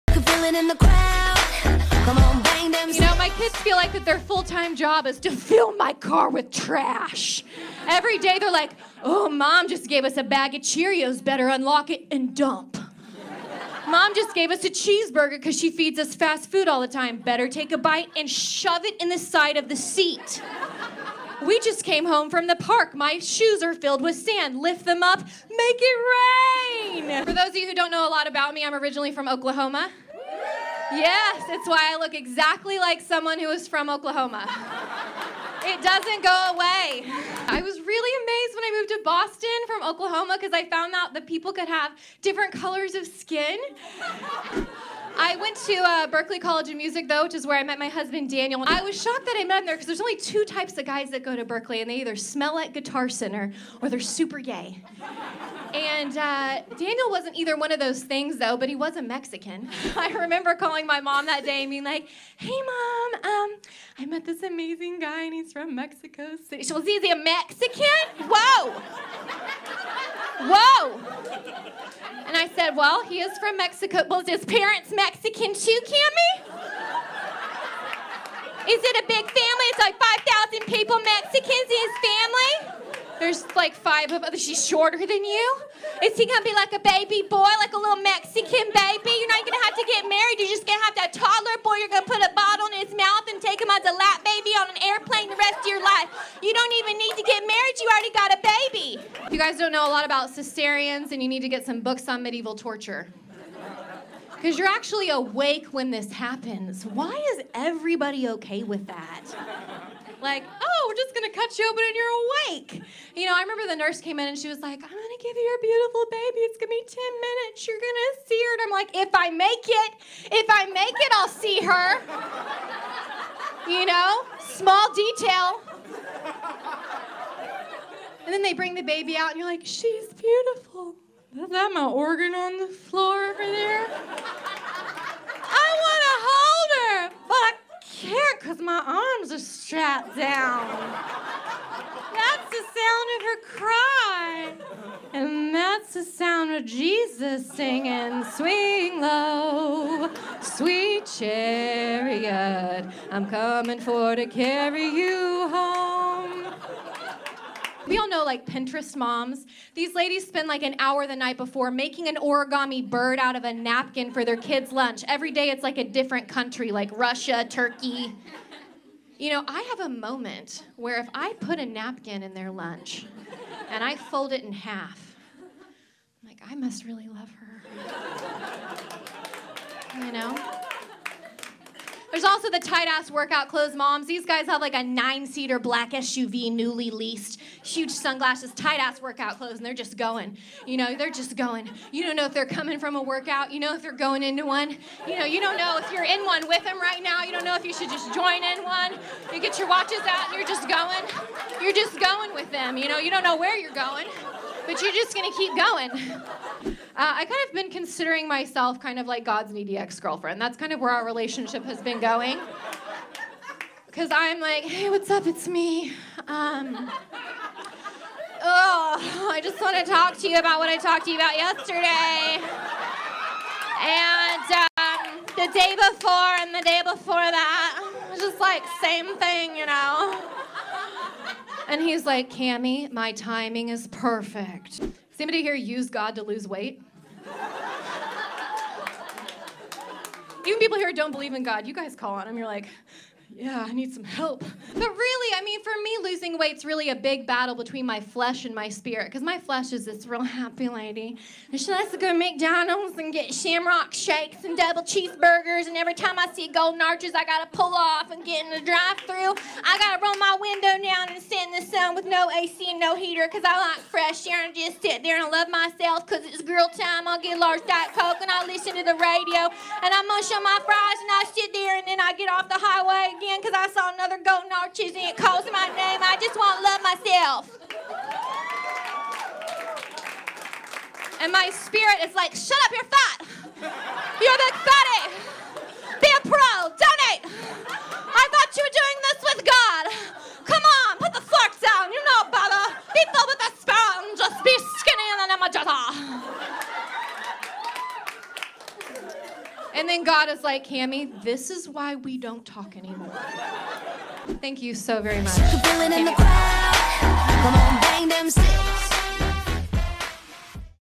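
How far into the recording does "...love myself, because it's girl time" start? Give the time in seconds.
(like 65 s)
265 s.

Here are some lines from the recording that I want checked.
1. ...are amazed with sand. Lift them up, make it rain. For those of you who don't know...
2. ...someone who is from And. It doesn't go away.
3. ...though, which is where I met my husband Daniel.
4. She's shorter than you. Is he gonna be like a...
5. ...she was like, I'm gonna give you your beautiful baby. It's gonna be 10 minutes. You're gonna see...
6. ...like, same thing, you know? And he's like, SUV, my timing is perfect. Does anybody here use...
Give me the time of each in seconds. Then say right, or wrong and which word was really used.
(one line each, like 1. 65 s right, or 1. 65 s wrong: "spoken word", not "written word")
1. 23 s wrong: "filled", not "amazed"
2. 33 s wrong: "Oklahoma", not "And"
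3. 47 s right
4. 84 s right
5. 114 s right
6. 228 s wrong: "Cammy", not "SUV".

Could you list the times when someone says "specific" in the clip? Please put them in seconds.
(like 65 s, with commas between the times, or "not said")
not said.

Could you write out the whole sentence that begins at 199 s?
You get your watches out and you're just going.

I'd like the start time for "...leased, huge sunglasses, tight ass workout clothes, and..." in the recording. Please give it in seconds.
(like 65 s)
186 s.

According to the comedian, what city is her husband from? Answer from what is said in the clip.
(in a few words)
Mexico City.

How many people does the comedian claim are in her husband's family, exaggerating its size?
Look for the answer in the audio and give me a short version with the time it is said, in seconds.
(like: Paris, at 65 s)
5,000, at 79 s.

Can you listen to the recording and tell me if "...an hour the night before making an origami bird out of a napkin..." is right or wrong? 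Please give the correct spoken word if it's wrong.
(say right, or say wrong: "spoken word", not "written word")
right.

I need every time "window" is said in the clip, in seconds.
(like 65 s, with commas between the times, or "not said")
260 s.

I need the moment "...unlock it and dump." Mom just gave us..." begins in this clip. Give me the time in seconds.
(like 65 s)
11 s.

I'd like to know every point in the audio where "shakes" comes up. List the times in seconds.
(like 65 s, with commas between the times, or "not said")
253 s.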